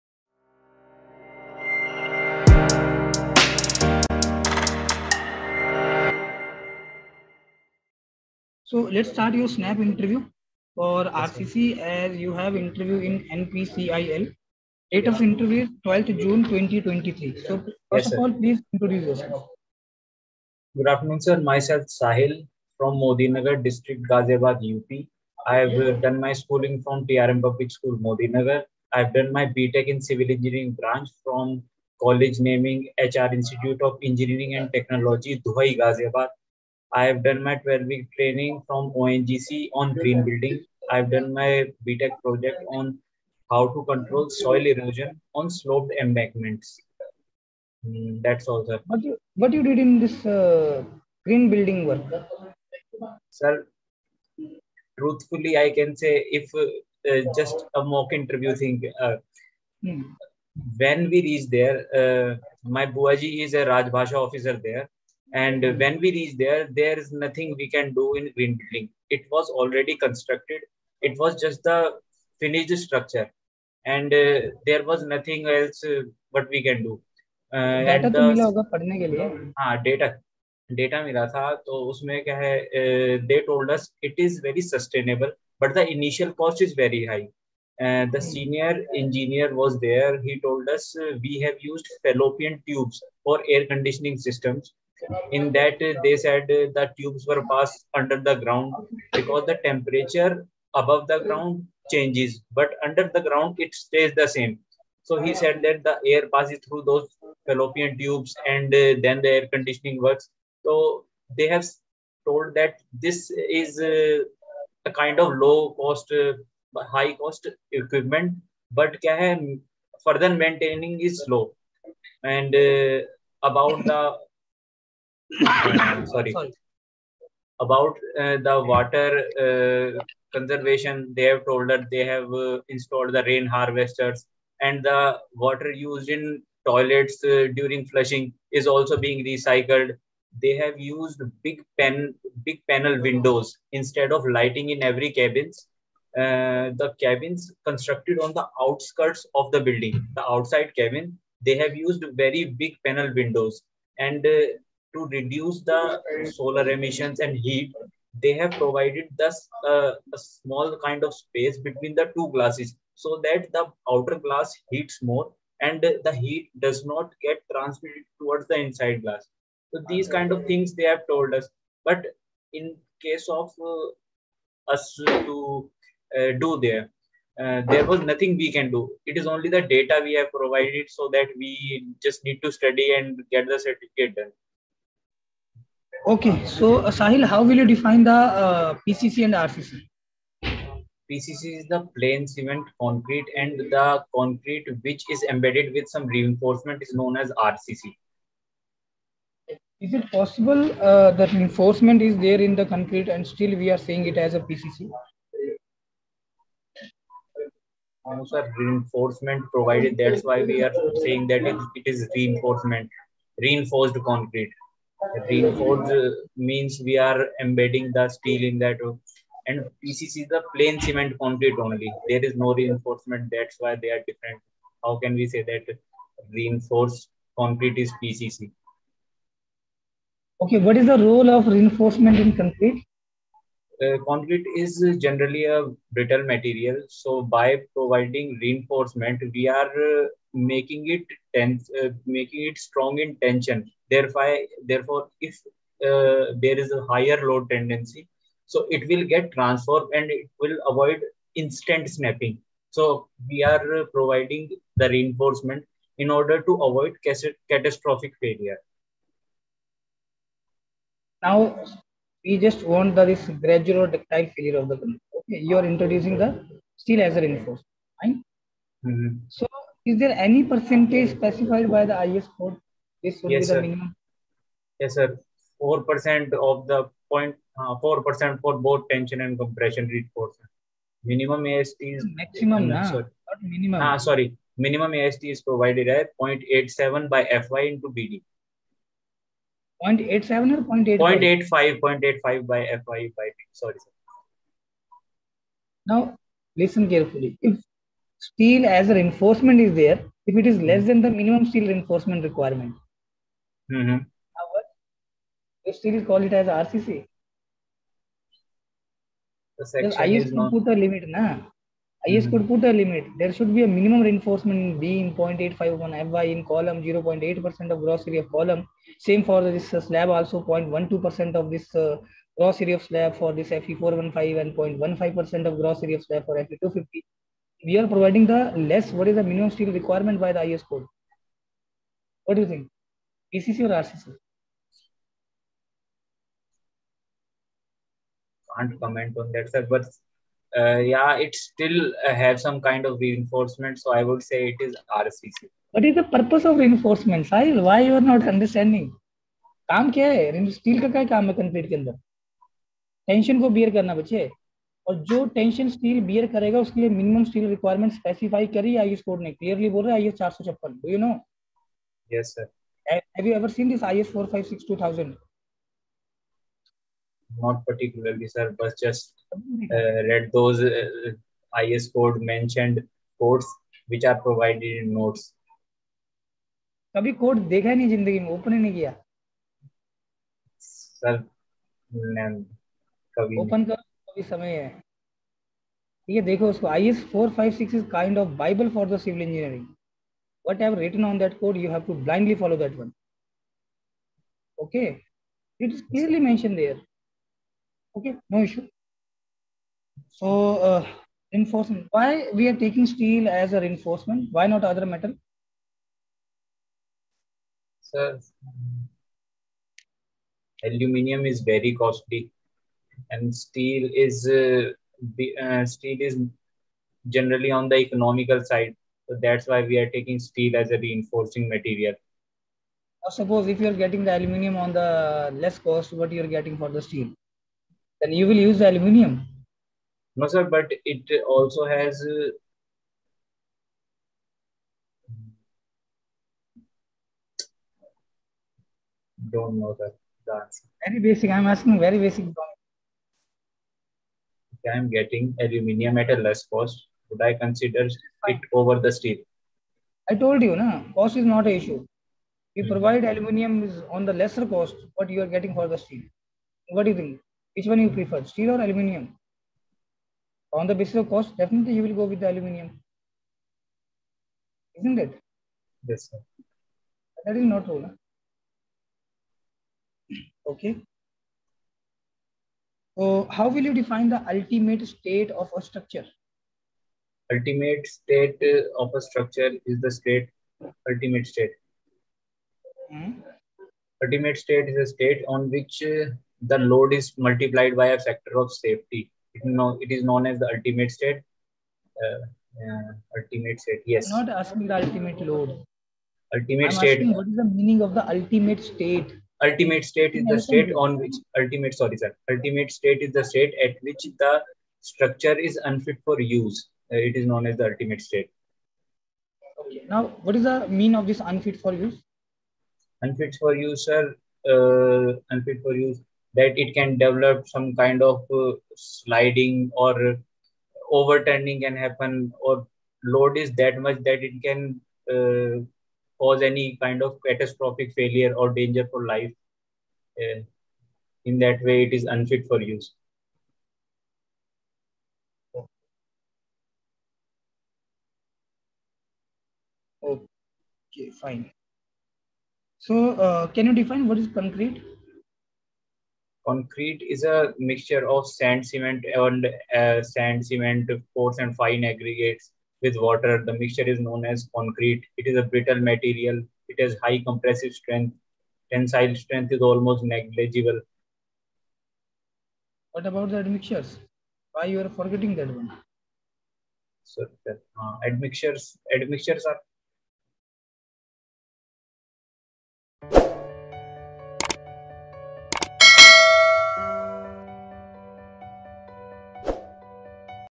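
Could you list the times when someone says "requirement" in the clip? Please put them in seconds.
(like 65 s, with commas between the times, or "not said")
302 s, 329 s.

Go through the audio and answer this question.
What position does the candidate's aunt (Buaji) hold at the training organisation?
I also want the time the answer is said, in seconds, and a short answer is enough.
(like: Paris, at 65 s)
Rajbhasha officer, at 63 s.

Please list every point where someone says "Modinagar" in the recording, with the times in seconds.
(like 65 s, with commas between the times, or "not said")
22 s, 27 s.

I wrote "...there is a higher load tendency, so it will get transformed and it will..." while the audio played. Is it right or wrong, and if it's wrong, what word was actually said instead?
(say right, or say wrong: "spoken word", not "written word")
right.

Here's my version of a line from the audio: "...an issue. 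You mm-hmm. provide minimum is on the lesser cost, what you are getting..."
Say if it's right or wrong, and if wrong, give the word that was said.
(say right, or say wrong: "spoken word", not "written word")
wrong: "aluminium", not "minimum".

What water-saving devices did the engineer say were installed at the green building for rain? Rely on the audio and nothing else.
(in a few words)
rain harvesters.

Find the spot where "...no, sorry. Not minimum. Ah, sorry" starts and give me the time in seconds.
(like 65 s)
282 s.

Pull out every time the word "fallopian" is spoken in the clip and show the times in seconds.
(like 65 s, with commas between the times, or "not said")
92 s, 107 s.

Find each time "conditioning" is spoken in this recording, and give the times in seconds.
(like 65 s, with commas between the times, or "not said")
93 s, 109 s.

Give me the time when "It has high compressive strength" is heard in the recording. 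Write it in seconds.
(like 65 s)
556 s.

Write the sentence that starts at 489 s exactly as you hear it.
It, no, it is known as the ultimate state.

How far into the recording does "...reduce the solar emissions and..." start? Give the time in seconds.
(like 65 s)
155 s.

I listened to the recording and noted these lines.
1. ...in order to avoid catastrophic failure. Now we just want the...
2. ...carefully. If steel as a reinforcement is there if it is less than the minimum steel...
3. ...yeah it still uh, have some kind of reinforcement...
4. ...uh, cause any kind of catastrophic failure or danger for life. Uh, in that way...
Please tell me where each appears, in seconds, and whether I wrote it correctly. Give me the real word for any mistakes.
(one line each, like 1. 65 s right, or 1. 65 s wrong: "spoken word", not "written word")
1. 255 s right
2. 296 s right
3. 340 s right
4. 525 s right.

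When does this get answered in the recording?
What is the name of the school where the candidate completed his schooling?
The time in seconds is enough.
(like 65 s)
27 s.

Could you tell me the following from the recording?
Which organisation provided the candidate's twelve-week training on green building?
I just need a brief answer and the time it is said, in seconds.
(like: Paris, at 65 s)
ONGC, at 38 s.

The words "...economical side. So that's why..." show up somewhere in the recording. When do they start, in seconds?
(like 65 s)
417 s.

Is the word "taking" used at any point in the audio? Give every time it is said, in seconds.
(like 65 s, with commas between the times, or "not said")
402 s, 419 s.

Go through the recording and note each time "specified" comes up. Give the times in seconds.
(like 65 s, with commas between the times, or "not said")
271 s.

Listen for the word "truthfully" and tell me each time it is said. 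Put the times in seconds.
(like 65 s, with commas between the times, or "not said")
54 s.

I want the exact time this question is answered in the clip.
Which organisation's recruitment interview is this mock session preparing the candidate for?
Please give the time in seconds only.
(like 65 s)
13 s.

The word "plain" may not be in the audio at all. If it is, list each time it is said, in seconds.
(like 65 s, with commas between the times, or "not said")
191 s, 220 s.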